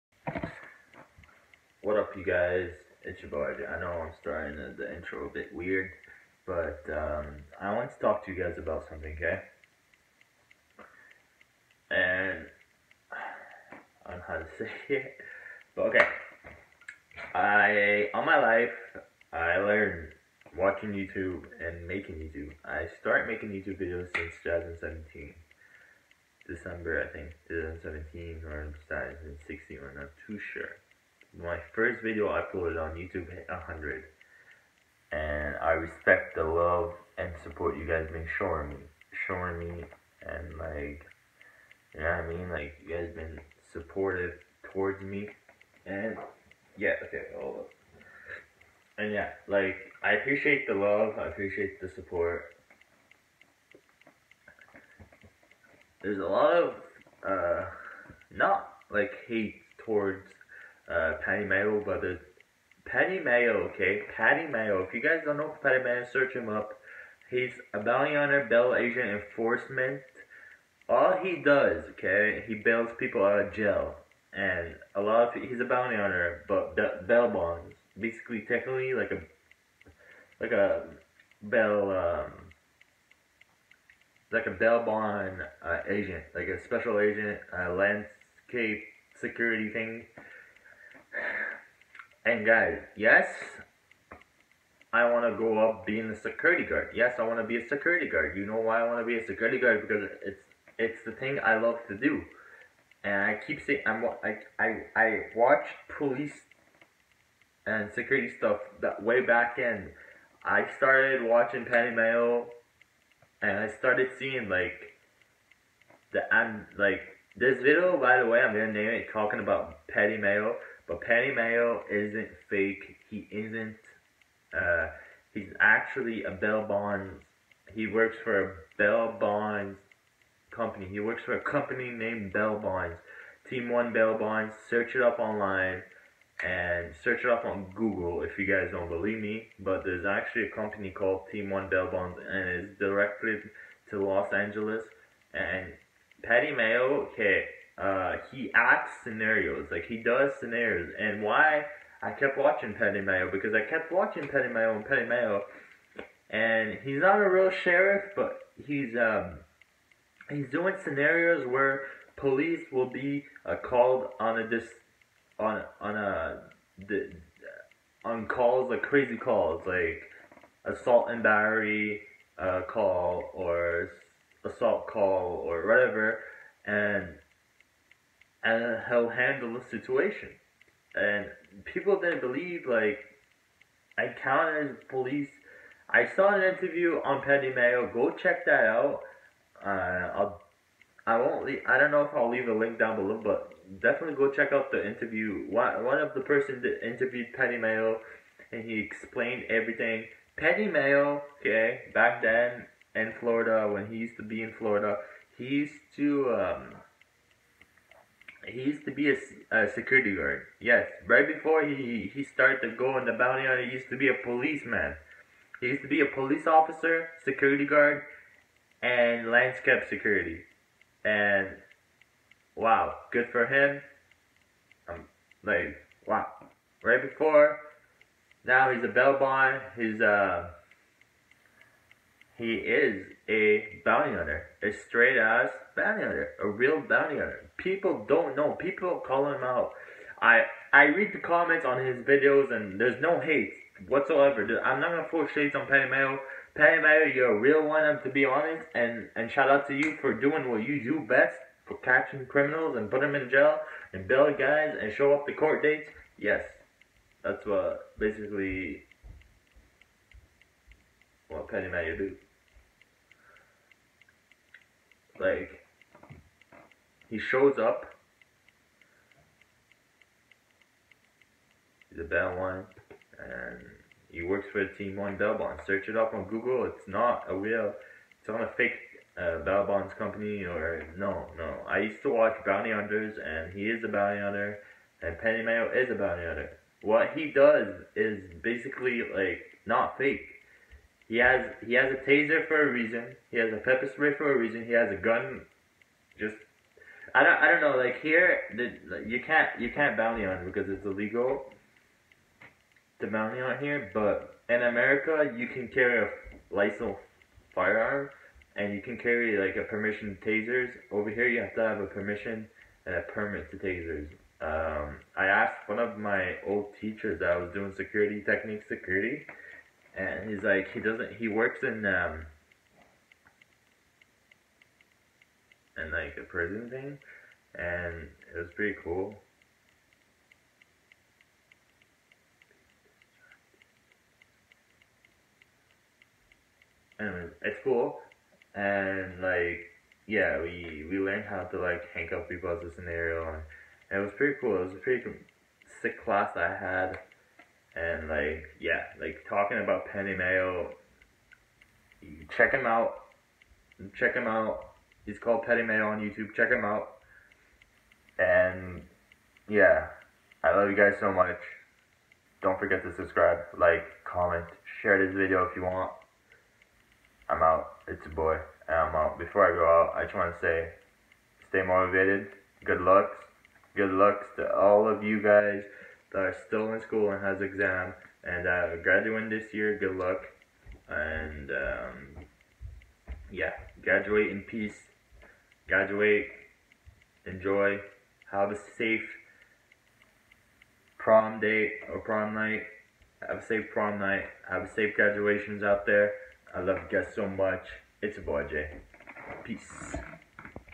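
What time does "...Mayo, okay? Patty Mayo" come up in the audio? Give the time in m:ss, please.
1:03.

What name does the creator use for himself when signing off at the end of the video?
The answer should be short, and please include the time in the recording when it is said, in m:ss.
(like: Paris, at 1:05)
Jay, at 6:38.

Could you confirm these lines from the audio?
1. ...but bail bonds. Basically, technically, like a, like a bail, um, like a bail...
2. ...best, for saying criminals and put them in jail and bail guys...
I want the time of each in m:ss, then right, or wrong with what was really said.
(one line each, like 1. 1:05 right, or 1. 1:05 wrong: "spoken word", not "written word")
1. 1:16 right
2. 4:11 wrong: "catching", not "saying".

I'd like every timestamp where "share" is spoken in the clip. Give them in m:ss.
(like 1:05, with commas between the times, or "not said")
6:04.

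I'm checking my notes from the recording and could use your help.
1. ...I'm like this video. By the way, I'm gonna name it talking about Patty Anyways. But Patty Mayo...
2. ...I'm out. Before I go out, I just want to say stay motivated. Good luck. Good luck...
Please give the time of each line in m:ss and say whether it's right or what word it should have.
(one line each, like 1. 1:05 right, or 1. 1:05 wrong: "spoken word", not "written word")
1. 1:56 wrong: "Mayo", not "Anyways"
2. 6:08 right.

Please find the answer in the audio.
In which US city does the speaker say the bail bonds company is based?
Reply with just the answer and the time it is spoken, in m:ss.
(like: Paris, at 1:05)
Los Angeles, at 2:24.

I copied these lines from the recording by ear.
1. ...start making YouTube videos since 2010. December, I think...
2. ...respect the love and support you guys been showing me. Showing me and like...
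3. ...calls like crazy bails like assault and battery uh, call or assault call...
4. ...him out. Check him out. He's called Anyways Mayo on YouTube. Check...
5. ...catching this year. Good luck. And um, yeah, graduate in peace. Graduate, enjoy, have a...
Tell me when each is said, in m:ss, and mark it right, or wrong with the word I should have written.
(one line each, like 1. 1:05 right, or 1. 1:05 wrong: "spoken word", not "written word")
1. 0:22 wrong: "2017", not "2010"
2. 0:35 right
3. 2:48 wrong: "calls", not "bails"
4. 5:52 wrong: "Patty", not "Anyways"
5. 6:18 wrong: "graduating", not "catching".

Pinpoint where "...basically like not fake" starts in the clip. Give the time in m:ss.
4:48.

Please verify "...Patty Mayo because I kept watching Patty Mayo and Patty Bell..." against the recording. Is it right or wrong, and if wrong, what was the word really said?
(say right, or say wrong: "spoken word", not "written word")
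wrong: "Mayo", not "Bell".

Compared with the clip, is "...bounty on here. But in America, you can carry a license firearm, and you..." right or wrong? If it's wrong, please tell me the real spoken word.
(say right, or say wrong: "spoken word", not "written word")
right.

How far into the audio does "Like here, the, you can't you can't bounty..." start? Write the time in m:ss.
4:57.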